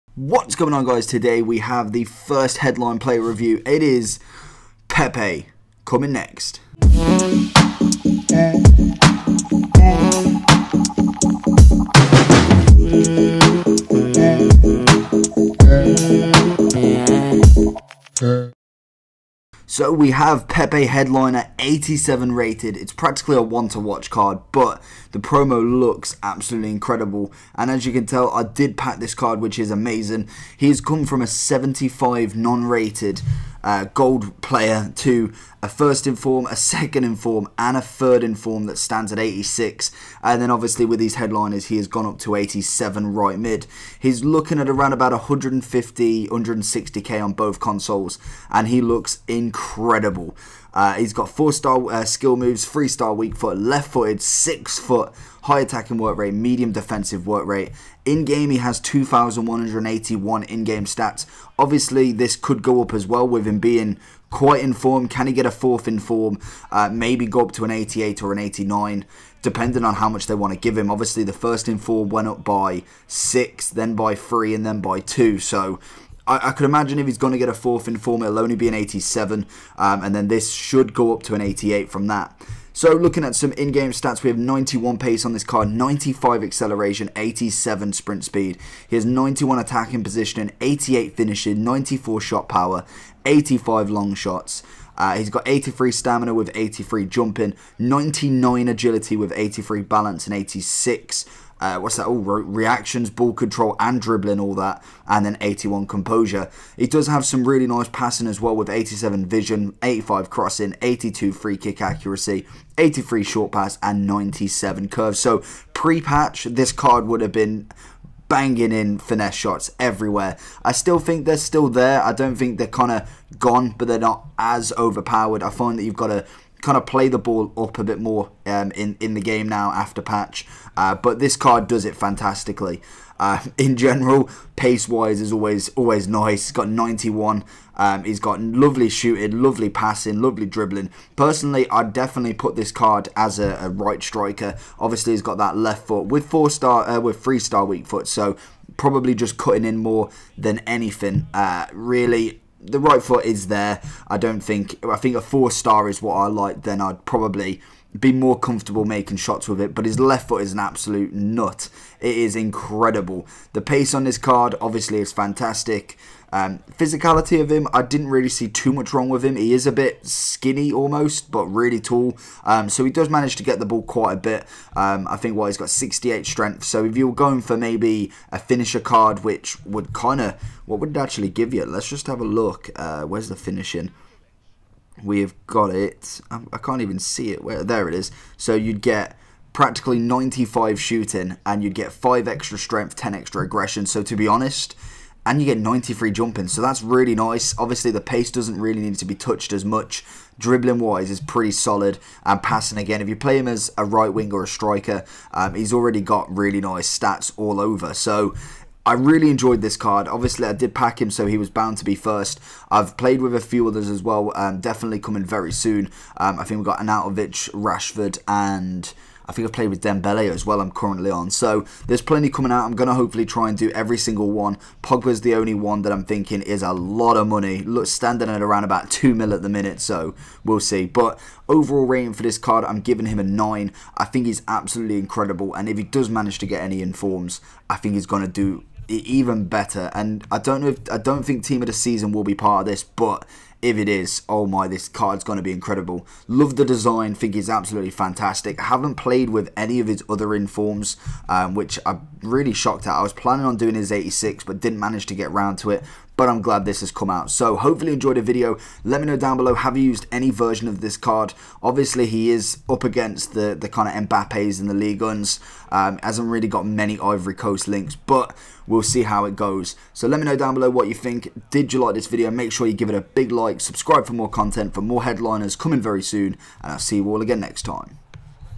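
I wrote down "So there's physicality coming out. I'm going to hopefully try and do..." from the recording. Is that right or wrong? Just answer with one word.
wrong.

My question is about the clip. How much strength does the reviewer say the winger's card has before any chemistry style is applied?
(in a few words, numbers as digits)
68.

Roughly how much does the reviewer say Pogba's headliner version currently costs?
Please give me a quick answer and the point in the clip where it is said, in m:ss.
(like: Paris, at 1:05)
2 million, at 3:48.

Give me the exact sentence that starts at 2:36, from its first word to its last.
Then I'd probably be more comfortable making shots with it.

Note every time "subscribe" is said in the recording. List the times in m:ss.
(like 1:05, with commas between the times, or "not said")
4:33.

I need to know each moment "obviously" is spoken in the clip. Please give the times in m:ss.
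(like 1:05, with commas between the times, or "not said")
0:40, 1:01, 1:10, 2:24, 2:44, 3:17, 3:30, 4:21.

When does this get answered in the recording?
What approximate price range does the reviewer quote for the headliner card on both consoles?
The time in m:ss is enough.
0:45.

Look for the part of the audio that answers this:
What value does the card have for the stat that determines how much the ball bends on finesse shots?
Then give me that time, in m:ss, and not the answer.
1:54.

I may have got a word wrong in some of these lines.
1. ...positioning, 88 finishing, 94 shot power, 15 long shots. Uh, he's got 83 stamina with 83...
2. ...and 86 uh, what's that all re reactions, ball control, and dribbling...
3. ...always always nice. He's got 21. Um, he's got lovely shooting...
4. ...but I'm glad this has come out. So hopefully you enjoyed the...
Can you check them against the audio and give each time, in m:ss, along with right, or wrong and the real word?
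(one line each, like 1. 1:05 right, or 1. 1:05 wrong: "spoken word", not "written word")
1. 1:30 wrong: "85", not "15"
2. 1:40 right
3. 2:15 wrong: "91", not "21"
4. 4:16 right.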